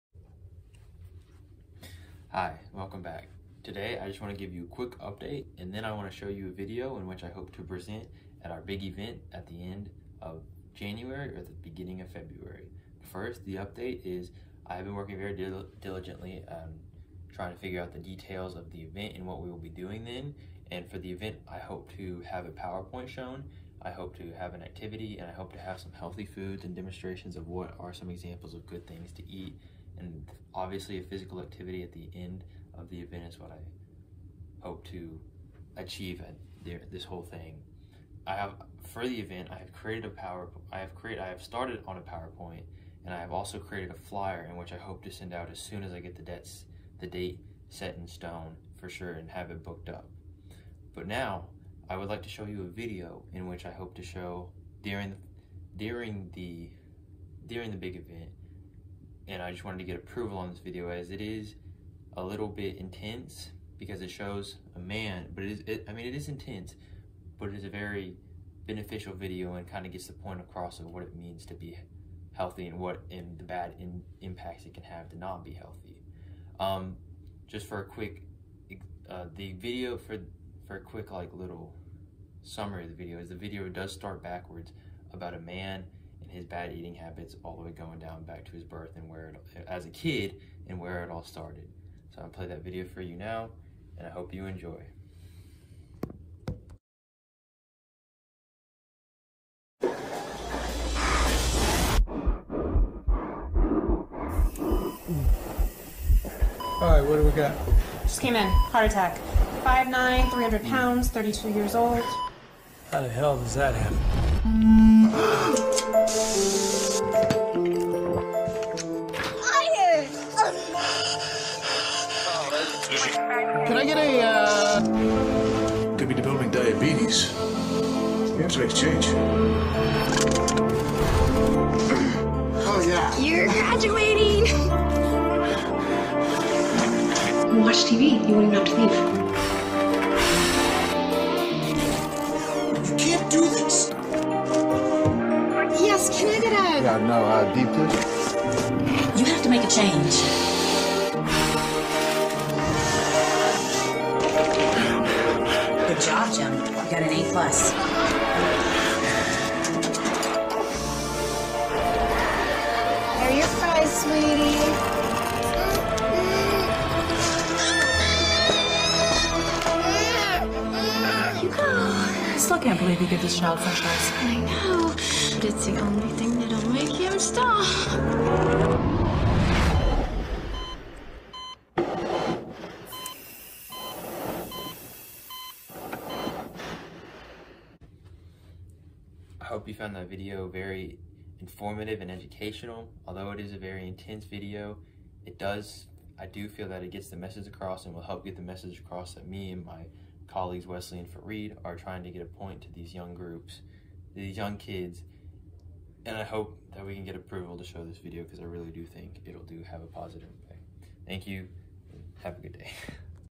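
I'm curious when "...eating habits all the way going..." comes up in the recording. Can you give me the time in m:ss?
1:26.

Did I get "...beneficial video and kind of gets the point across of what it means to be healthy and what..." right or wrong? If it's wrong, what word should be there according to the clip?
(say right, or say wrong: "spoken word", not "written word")
right.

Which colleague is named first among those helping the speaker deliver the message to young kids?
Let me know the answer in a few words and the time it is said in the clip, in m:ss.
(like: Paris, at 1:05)
Wesley, at 3:20.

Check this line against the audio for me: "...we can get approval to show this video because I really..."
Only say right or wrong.
right.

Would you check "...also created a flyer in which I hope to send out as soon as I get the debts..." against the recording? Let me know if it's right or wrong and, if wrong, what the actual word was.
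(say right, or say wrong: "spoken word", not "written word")
right.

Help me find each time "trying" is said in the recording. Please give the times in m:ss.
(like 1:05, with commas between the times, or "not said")
0:17, 3:21.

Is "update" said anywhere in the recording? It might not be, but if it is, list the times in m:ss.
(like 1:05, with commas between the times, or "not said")
0:04, 0:13.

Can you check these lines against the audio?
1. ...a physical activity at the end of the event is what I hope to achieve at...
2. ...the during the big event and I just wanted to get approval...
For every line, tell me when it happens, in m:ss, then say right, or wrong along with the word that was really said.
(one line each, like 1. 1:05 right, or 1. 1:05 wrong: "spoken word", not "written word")
1. 0:30 right
2. 0:56 right.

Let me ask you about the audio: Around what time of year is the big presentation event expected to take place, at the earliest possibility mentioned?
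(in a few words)
End of January.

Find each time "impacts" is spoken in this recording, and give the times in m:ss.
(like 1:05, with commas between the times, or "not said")
1:14, 3:30.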